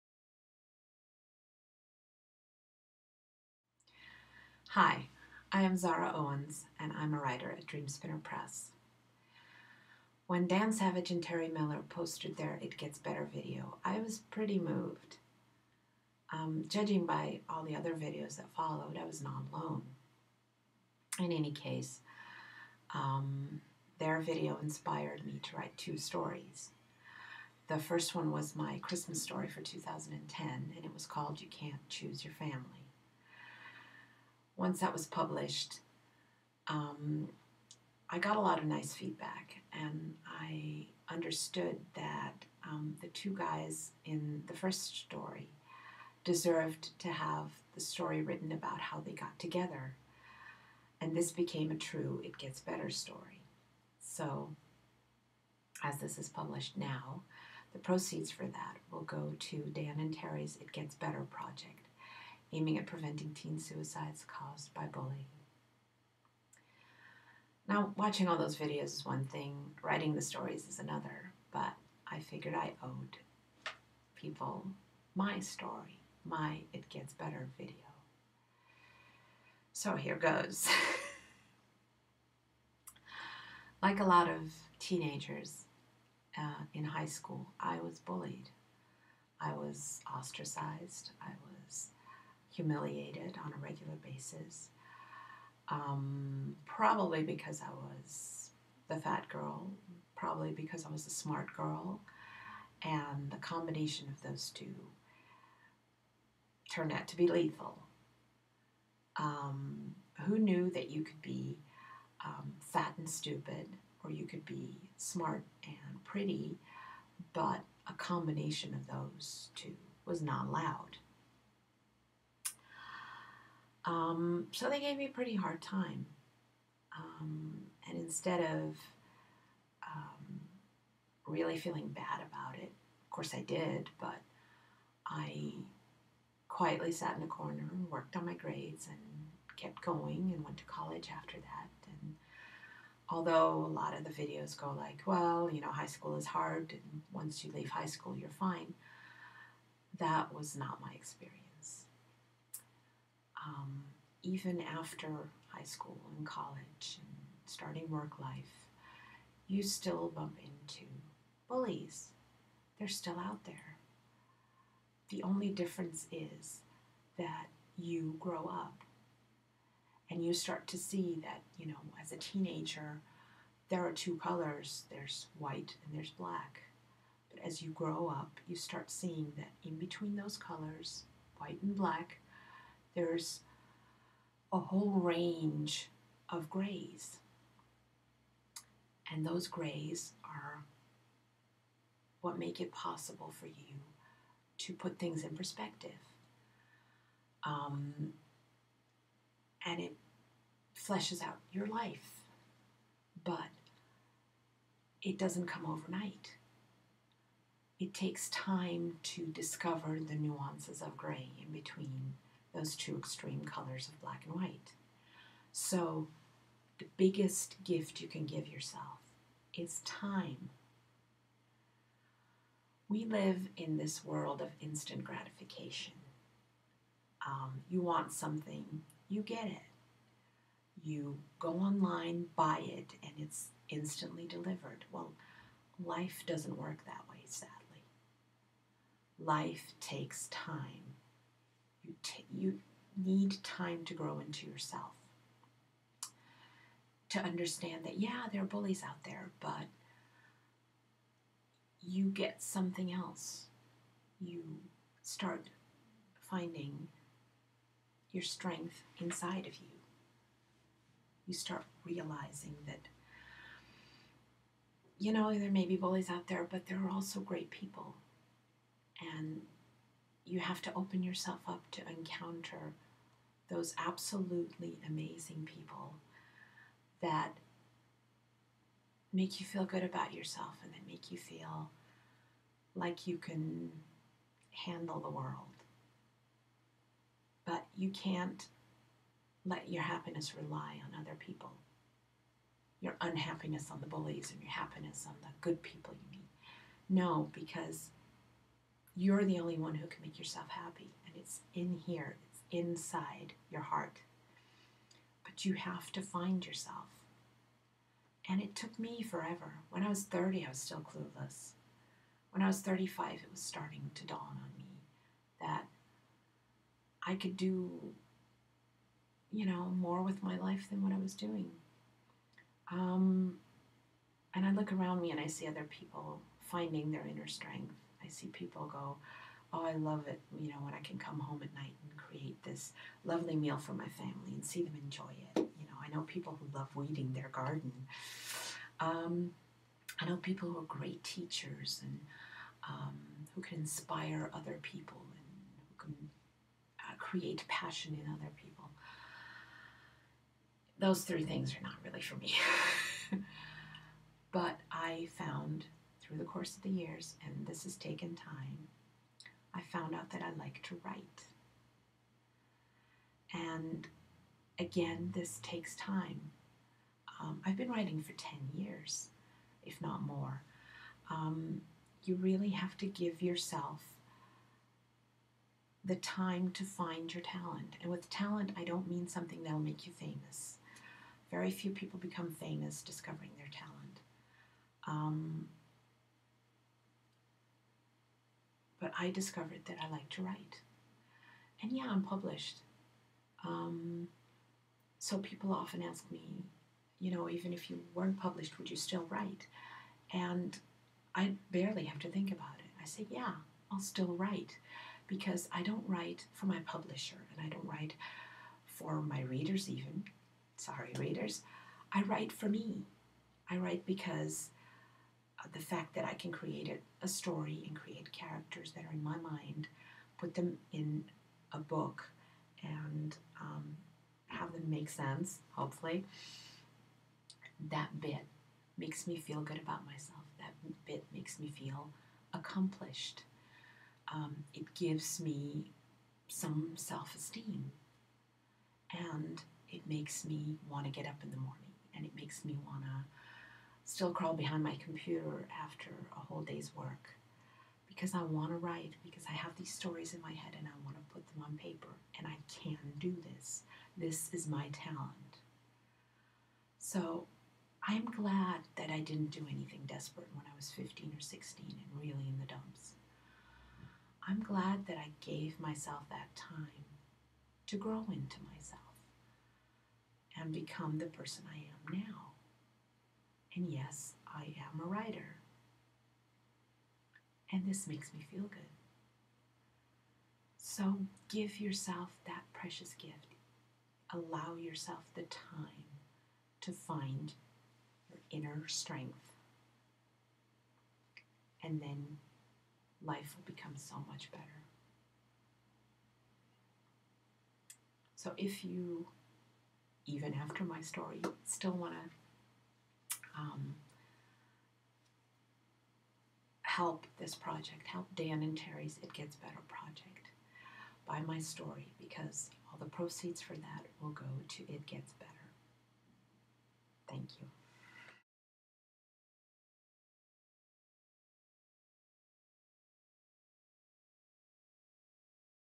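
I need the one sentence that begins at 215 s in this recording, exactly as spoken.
So, the biggest gift you can give yourself is time.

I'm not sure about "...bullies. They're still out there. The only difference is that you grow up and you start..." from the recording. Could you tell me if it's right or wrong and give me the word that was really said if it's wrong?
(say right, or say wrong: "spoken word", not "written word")
right.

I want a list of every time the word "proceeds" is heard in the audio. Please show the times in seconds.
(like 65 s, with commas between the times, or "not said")
57 s, 512 s.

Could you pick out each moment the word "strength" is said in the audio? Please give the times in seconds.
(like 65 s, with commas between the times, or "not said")
258 s, 327 s, 488 s.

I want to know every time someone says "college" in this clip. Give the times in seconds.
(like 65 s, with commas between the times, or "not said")
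140 s, 156 s.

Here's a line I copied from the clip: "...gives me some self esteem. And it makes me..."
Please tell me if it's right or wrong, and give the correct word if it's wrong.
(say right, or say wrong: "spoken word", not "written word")
right.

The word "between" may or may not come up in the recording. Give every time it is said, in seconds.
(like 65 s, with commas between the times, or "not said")
179 s, 211 s.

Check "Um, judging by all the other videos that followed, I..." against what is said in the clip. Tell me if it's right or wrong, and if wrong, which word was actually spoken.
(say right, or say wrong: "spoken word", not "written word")
right.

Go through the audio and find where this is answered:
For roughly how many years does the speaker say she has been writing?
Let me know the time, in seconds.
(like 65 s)
368 s.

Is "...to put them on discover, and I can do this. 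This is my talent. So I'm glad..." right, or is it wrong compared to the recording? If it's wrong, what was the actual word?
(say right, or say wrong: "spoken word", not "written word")
wrong: "paper", not "discover".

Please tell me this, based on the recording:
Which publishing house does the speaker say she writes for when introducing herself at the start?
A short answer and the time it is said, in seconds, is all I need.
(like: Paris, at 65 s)
Dreamspinner Press, at 7 s.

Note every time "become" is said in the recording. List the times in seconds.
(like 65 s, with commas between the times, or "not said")
381 s, 470 s, 493 s.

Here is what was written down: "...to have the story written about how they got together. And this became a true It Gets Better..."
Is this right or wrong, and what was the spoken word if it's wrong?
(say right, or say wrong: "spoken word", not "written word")
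right.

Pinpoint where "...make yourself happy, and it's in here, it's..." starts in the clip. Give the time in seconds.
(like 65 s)
300 s.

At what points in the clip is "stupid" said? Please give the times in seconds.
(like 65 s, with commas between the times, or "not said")
113 s.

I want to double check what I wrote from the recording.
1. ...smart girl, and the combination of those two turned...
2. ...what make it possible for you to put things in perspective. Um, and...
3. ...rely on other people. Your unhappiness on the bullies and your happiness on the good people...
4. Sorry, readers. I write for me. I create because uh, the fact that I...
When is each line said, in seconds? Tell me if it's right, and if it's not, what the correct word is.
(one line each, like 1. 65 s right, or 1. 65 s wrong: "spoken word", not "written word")
1. 101 s right
2. 192 s right
3. 290 s right
4. 410 s wrong: "write", not "create".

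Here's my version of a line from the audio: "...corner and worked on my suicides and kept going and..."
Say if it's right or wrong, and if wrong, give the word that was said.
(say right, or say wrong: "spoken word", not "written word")
wrong: "grades", not "suicides".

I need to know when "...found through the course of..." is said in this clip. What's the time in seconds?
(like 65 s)
355 s.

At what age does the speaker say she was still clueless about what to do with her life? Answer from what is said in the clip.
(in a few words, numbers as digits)
30.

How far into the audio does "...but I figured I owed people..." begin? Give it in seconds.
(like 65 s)
71 s.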